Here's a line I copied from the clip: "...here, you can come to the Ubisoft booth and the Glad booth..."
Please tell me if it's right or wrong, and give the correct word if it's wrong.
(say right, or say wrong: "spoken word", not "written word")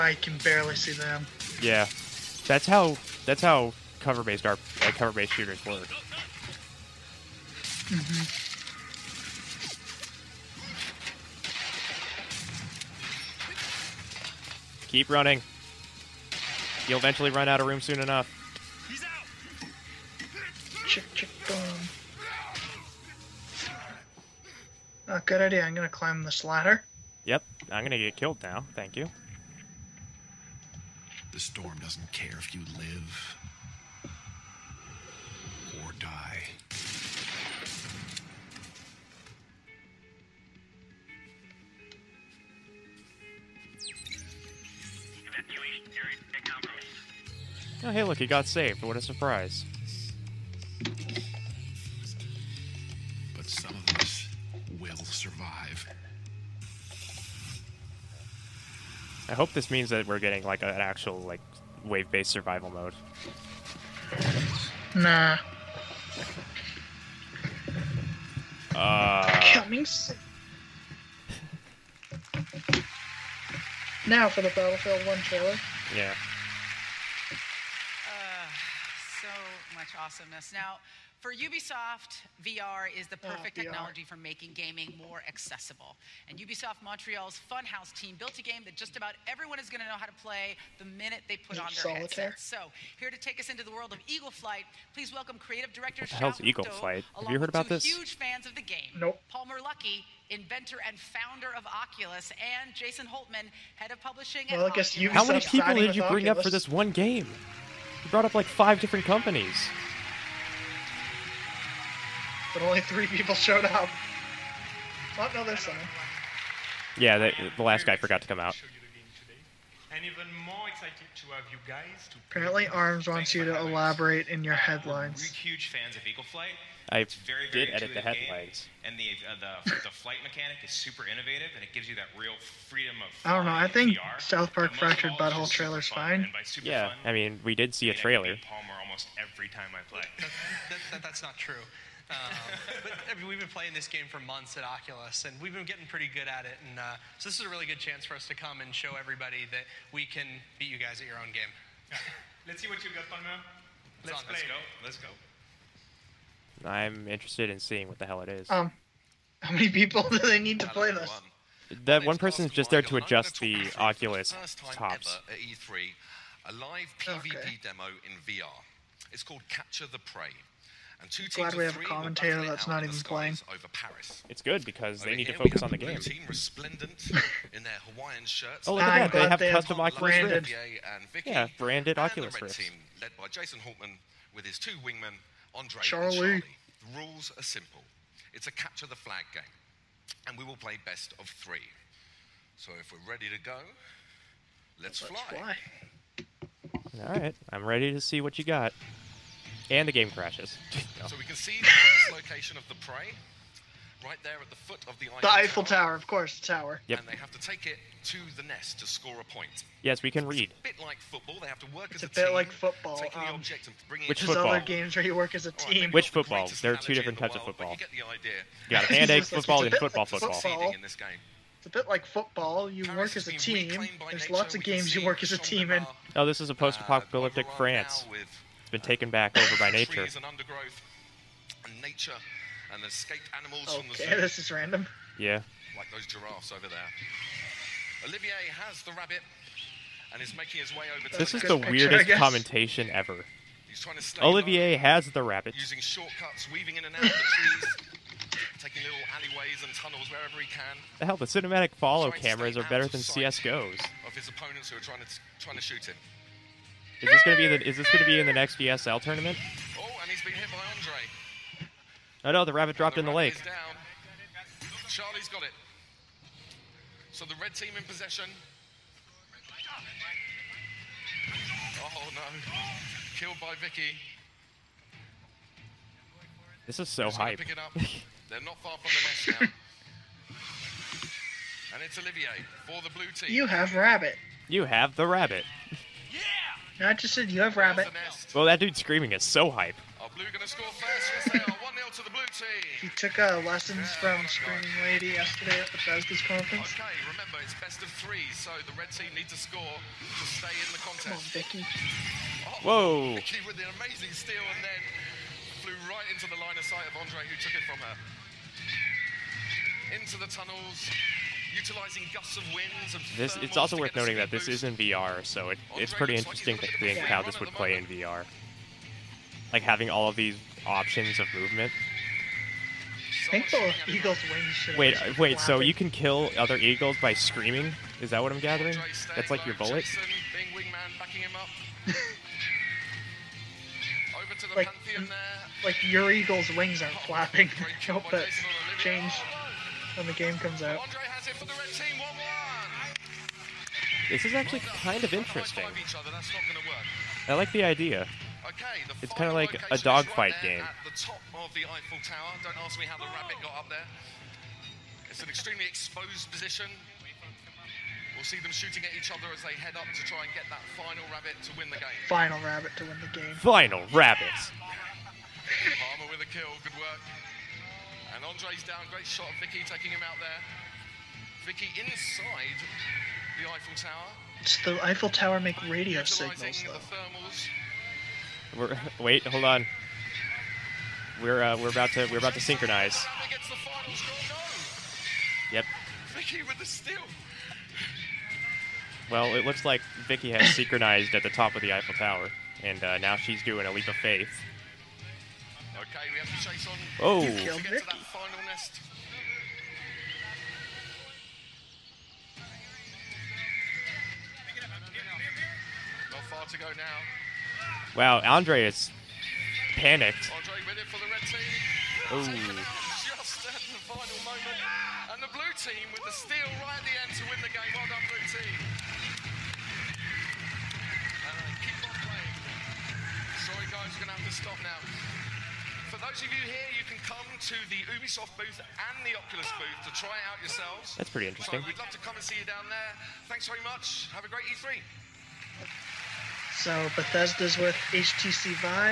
wrong: "Oculus", not "Glad".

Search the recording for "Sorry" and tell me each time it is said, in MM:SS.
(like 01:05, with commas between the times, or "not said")
07:03.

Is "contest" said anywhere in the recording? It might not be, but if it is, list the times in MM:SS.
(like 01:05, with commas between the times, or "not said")
05:00.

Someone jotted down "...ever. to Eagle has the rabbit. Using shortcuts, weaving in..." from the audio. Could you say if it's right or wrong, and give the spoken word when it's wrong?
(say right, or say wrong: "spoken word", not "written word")
wrong: "Olivier", not "Eagle".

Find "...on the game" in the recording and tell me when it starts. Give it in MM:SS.
02:55.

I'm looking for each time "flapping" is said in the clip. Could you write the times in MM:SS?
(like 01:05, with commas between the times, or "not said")
05:37.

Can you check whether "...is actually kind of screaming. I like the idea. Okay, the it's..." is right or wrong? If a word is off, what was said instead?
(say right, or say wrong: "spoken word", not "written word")
wrong: "interesting", not "screaming".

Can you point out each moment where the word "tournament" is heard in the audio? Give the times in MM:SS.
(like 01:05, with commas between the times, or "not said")
04:18.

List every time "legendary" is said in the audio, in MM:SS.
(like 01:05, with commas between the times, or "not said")
not said.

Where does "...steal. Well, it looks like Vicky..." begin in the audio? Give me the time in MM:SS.
06:26.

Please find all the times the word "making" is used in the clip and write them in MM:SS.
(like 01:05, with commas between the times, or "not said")
01:24, 04:00.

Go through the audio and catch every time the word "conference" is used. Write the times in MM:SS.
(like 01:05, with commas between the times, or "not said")
04:56.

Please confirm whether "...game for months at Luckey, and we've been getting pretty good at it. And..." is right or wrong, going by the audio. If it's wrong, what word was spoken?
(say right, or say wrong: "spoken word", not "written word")
wrong: "Oculus", not "Luckey".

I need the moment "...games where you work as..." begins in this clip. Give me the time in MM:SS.
03:34.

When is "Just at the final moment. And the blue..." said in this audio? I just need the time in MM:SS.
06:52.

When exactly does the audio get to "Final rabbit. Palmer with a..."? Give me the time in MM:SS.
06:03.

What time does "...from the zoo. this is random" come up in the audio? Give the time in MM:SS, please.
03:53.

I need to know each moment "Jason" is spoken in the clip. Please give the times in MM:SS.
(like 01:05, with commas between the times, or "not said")
01:42, 03:03.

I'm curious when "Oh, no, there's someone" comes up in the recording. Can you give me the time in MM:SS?
01:55.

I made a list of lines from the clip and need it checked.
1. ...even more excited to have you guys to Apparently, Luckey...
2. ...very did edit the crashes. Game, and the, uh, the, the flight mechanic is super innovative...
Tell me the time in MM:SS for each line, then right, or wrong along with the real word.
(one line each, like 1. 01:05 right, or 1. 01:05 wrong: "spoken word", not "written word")
1. 02:00 wrong: "Arms", not "Luckey"
2. 02:07 wrong: "headlines", not "crashes".